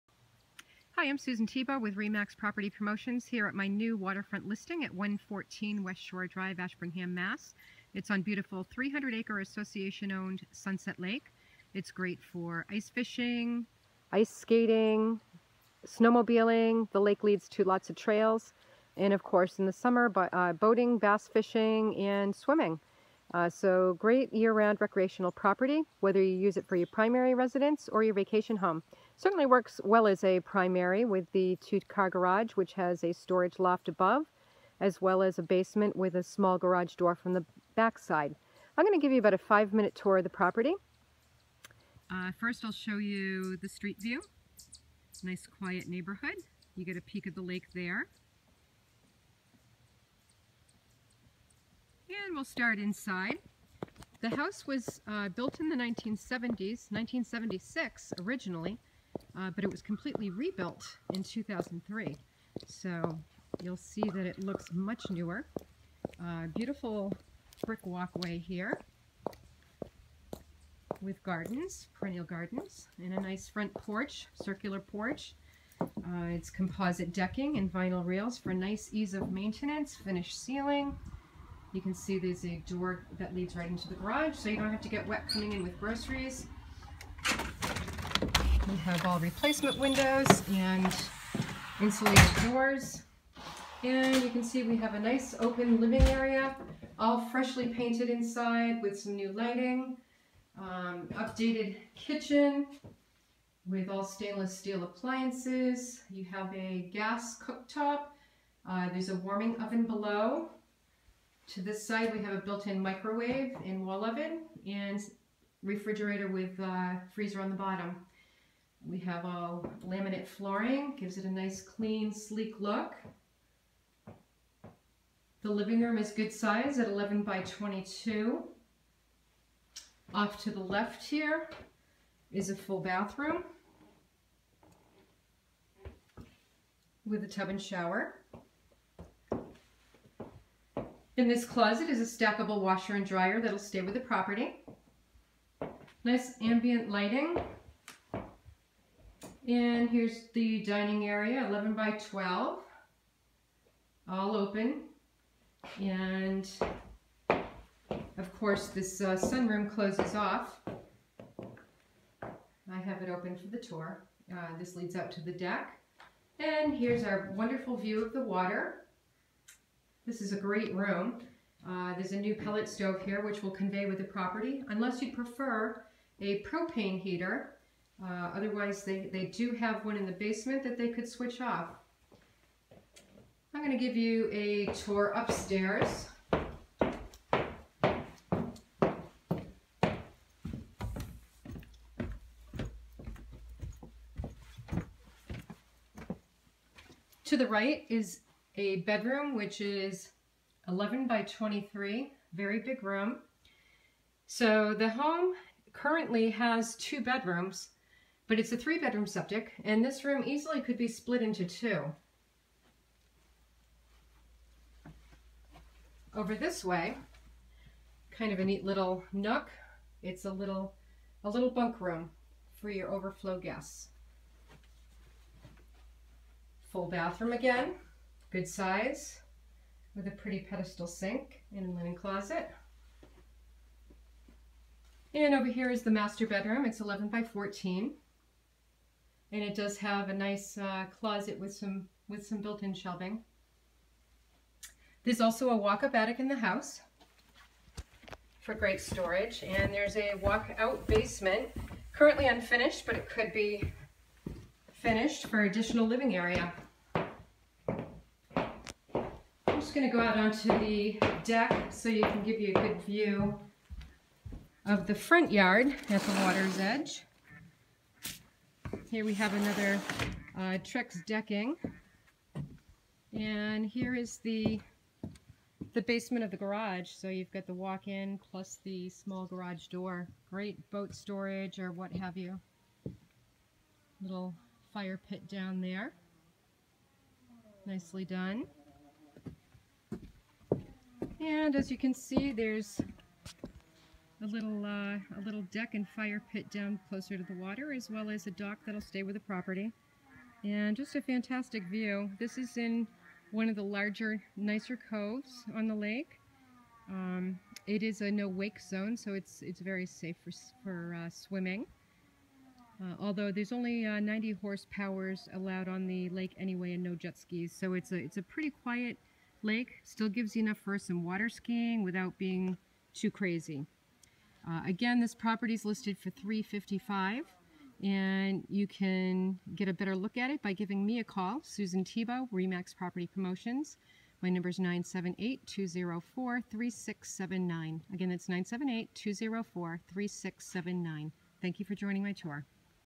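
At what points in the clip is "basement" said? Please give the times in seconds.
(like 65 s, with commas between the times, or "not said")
35 s, 180 s, 250 s, 275 s.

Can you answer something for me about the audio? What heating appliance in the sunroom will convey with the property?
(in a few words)
Pellet stove.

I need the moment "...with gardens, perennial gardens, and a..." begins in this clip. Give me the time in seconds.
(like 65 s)
71 s.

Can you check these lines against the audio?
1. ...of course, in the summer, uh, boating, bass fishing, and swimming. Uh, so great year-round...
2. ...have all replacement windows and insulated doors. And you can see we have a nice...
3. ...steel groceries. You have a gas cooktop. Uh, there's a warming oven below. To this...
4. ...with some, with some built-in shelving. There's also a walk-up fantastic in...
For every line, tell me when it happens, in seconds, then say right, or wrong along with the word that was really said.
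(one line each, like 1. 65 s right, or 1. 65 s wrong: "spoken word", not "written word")
1. 19 s right
2. 88 s right
3. 104 s wrong: "appliances", not "groceries"
4. 241 s wrong: "attic", not "fantastic".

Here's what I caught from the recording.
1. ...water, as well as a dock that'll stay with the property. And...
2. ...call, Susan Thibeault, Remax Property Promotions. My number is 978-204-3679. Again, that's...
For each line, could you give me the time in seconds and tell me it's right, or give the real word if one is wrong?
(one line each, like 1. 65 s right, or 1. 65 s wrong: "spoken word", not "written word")
1. 297 s right
2. 331 s right.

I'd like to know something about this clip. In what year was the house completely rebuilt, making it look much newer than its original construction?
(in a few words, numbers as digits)
2003.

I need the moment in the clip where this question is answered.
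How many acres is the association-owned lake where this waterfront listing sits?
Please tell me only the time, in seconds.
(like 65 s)
8 s.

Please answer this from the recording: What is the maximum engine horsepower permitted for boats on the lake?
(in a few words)
90.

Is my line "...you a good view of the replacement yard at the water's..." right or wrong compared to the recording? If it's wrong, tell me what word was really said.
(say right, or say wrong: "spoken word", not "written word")
wrong: "front", not "replacement".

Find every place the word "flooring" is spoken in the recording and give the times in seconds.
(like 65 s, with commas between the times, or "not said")
120 s.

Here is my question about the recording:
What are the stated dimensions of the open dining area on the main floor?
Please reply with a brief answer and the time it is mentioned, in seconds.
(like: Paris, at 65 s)
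11 by 12, at 151 s.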